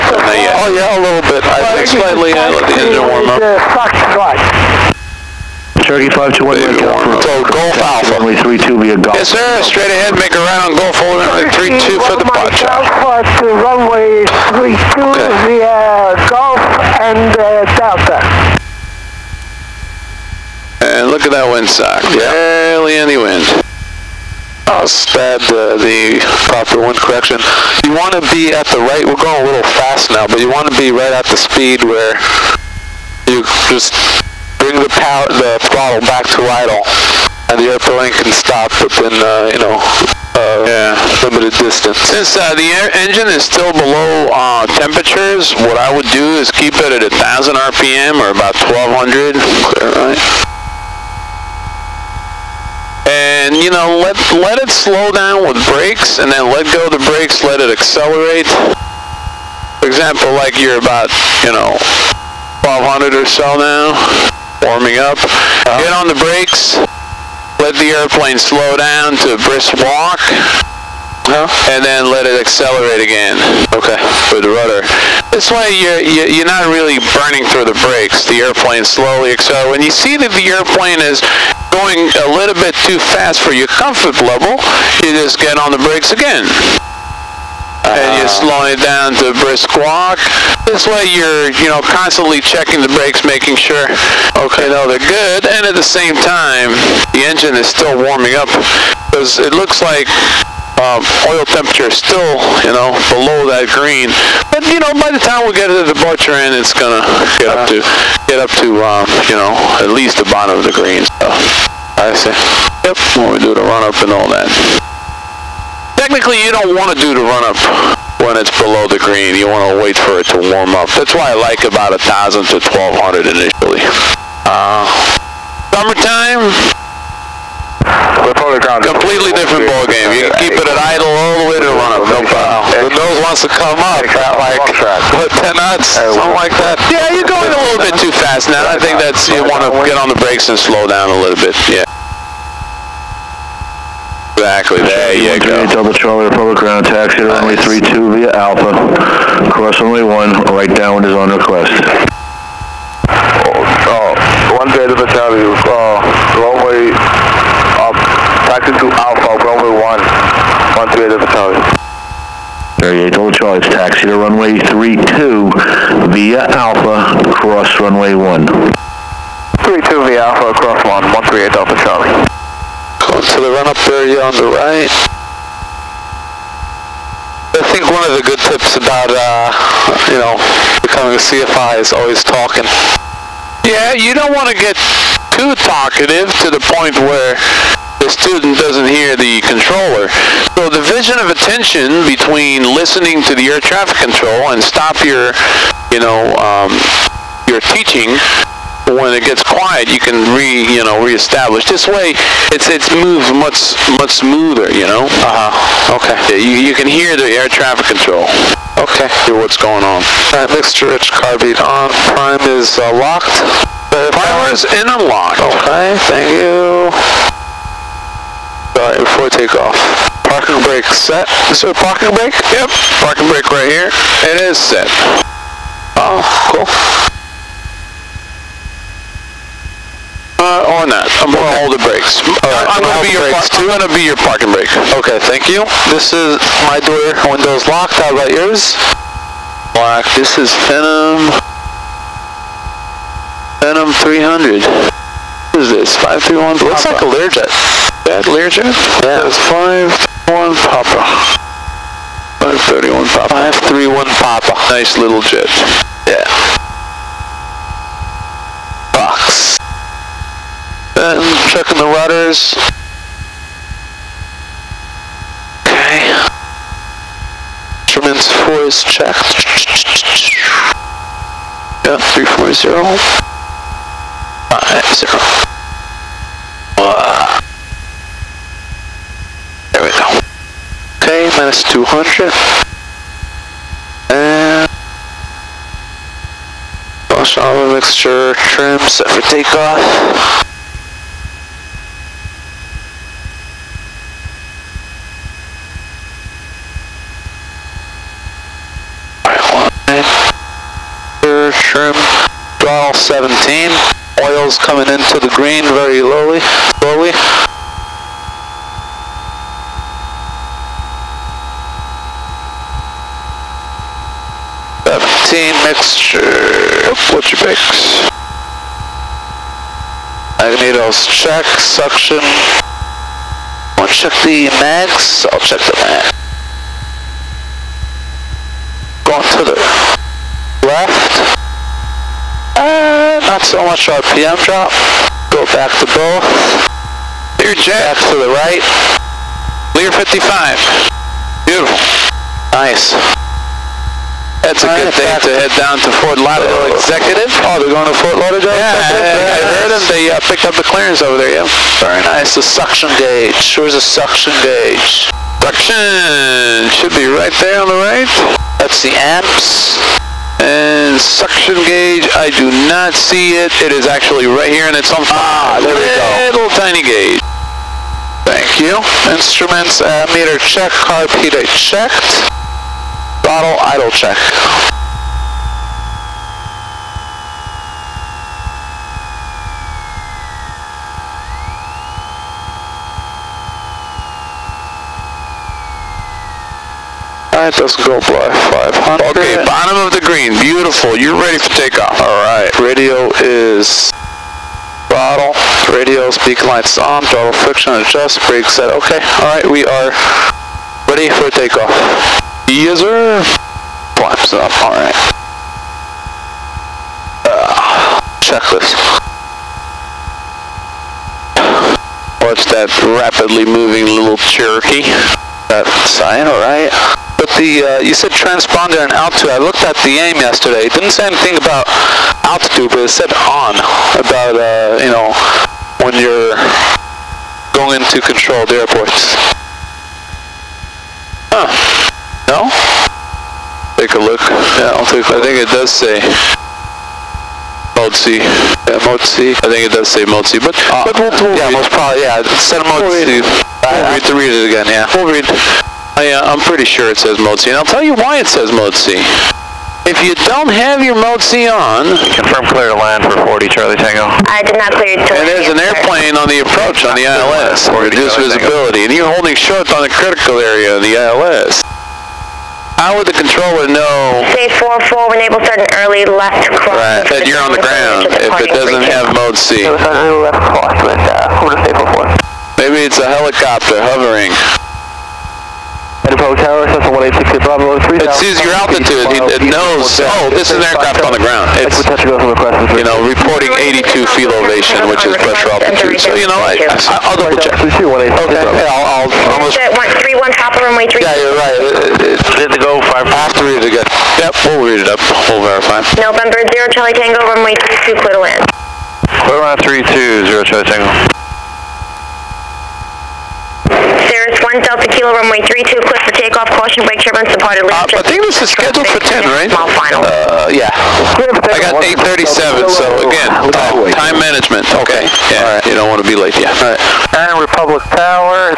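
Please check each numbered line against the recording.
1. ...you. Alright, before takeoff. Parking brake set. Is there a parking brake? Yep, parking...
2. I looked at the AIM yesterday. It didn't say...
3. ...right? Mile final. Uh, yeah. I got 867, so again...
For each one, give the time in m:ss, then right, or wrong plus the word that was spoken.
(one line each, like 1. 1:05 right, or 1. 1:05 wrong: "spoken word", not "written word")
1. 3:36 right
2. 6:59 right
3. 8:29 wrong: "837", not "867".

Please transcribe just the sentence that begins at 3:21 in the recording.
This way, it's it's moves much much smoother.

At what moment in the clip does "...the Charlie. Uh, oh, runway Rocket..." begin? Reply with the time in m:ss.
2:34.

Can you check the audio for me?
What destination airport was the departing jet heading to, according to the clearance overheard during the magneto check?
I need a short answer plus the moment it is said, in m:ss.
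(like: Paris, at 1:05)
Fort Lauderdale Executive, at 5:46.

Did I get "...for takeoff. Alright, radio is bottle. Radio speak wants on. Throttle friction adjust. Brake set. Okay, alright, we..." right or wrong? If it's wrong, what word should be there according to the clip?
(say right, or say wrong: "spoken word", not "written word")
wrong: "lights", not "wants".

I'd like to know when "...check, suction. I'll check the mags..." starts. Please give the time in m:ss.
5:21.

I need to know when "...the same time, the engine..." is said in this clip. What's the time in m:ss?
1:35.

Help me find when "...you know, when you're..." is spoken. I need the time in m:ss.
7:04.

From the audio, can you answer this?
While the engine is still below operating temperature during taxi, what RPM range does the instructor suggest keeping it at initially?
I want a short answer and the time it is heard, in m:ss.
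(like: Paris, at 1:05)
1,000 to 1,200, at 2:01.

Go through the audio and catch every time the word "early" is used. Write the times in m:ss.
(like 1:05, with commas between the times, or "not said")
7:45.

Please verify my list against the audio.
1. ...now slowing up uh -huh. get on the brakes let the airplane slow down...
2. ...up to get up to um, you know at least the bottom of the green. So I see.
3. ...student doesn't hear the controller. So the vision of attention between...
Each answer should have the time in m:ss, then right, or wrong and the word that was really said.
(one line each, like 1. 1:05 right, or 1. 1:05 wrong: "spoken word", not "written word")
1. 1:03 wrong: "warming", not "slowing"
2. 1:47 right
3. 3:08 right.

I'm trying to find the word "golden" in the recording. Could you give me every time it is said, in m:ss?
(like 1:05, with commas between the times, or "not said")
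not said.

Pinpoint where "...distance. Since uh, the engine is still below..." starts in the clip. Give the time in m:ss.
0:41.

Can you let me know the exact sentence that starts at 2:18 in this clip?
I think that's you want to get on the brakes and slow down a little bit.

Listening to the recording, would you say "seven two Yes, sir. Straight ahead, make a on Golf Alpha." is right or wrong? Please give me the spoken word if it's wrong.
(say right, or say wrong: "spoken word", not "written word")
wrong: "three", not "seven".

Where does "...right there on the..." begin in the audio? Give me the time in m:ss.
5:57.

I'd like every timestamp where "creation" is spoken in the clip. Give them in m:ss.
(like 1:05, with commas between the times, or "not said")
not said.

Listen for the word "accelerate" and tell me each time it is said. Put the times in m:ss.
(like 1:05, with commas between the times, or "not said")
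0:57, 1:12, 1:19.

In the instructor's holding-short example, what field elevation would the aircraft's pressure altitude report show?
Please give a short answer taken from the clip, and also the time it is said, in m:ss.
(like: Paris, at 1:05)
82 feet, at 8:03.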